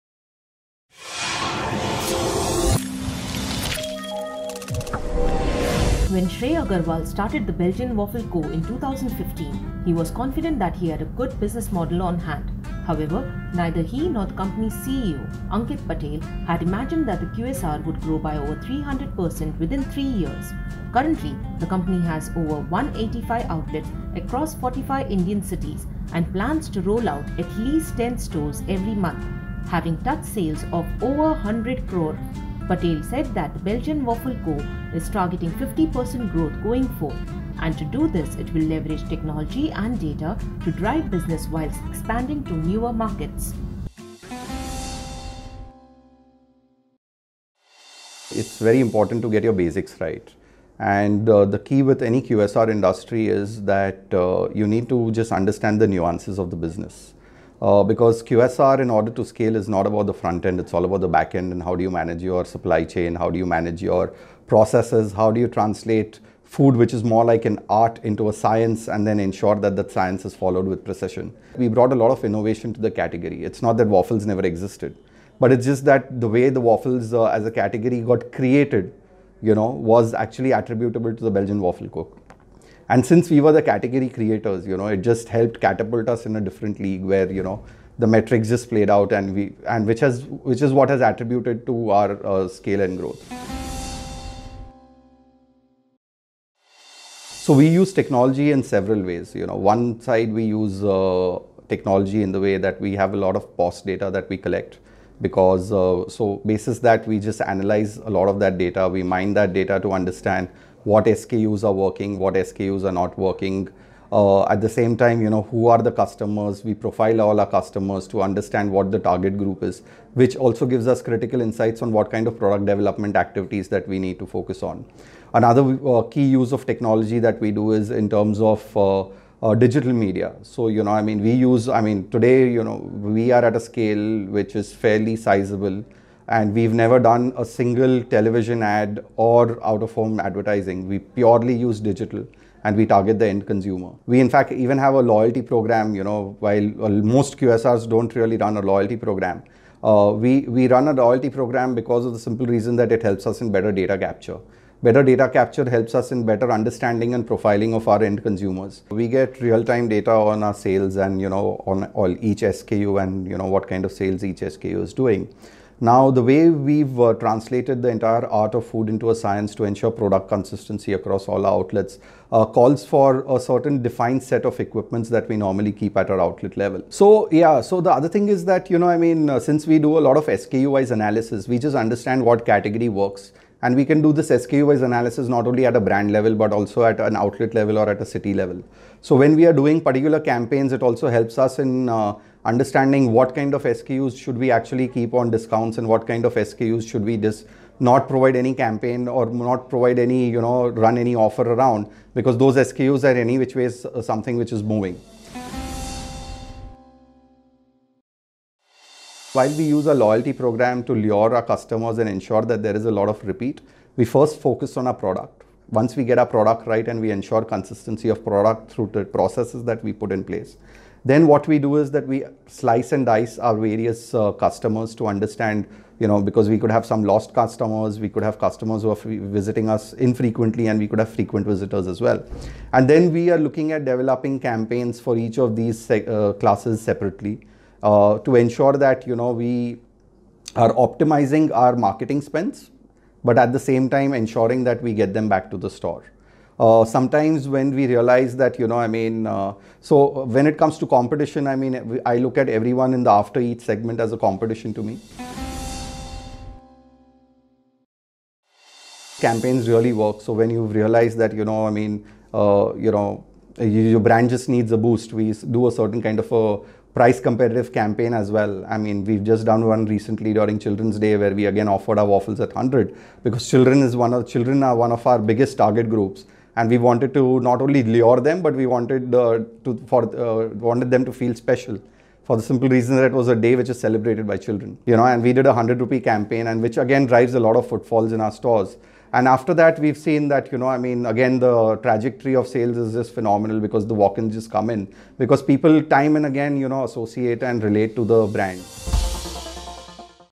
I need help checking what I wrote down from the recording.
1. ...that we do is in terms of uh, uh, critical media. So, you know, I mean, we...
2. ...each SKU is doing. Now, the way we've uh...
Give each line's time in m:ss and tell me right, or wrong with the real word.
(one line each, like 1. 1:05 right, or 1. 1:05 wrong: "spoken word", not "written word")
1. 2:07 wrong: "digital", not "critical"
2. 2:44 right.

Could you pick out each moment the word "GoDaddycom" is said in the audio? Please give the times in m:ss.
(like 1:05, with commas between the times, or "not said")
not said.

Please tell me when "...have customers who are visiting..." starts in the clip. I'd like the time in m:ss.
3:48.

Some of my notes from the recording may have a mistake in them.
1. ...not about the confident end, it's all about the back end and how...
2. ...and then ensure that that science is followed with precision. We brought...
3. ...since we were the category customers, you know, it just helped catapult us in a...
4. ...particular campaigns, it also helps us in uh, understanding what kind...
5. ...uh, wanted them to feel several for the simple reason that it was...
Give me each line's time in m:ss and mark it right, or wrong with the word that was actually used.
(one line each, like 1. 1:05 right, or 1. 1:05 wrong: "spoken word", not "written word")
1. 0:59 wrong: "front", not "confident"
2. 1:08 right
3. 1:23 wrong: "creators", not "customers"
4. 3:09 right
5. 4:40 wrong: "special", not "several".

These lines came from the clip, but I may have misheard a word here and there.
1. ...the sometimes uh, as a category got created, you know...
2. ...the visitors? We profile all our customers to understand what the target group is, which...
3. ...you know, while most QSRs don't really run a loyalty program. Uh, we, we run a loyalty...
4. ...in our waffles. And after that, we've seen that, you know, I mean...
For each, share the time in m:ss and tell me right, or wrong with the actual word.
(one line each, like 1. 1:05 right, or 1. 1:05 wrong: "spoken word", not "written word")
1. 1:16 wrong: "waffles", not "sometimes"
2. 1:55 wrong: "customers", not "visitors"
3. 2:25 right
4. 4:48 wrong: "stores", not "waffles".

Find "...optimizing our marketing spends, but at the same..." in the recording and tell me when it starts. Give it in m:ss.
4:00.